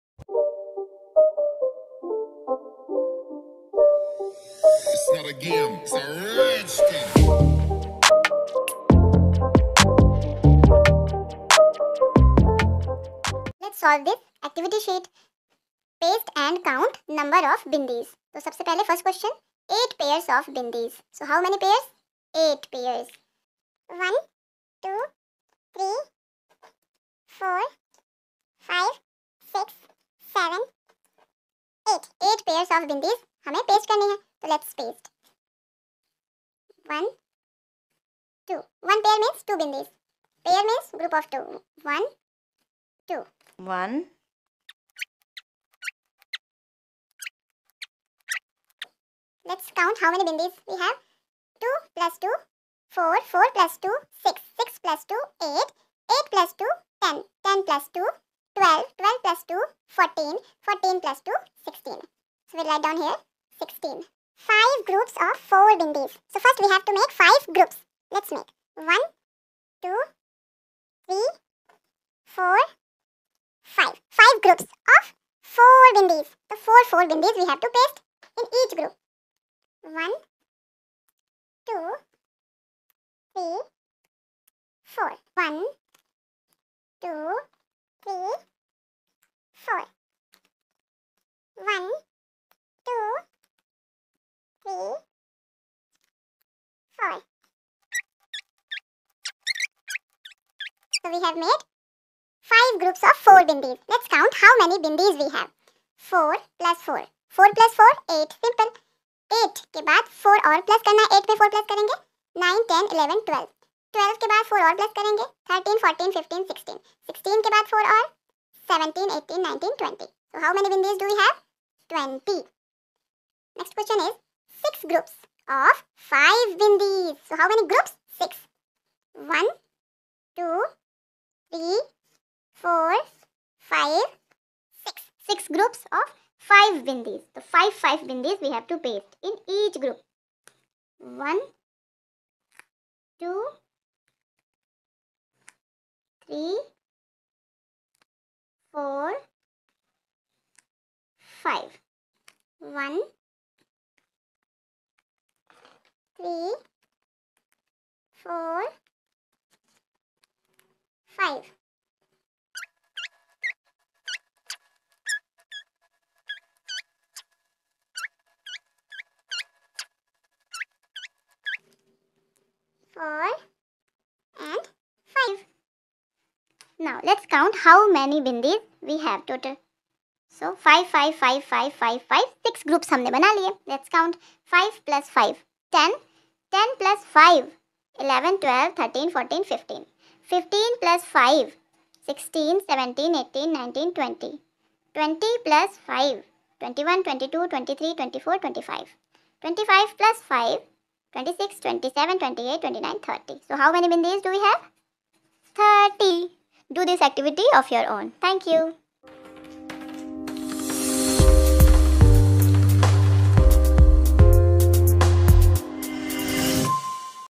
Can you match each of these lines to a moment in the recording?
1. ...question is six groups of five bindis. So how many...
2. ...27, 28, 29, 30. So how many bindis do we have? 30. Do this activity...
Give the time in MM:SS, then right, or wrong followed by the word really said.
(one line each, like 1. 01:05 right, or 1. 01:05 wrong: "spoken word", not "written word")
1. 02:03 right
2. 03:21 right.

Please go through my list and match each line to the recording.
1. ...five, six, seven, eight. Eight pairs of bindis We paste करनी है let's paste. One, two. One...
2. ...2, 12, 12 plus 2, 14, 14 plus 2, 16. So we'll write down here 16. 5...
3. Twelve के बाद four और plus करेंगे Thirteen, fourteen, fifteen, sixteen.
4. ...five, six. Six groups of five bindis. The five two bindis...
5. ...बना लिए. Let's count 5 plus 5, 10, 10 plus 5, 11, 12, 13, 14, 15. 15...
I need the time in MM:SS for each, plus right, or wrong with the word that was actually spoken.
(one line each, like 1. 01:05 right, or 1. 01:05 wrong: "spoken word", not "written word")
1. 00:28 right
2. 00:57 right
3. 01:53 right
4. 02:13 wrong: "five", not "two"
5. 03:03 right.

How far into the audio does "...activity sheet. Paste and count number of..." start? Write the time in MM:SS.
00:14.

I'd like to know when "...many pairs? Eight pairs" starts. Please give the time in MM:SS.
00:21.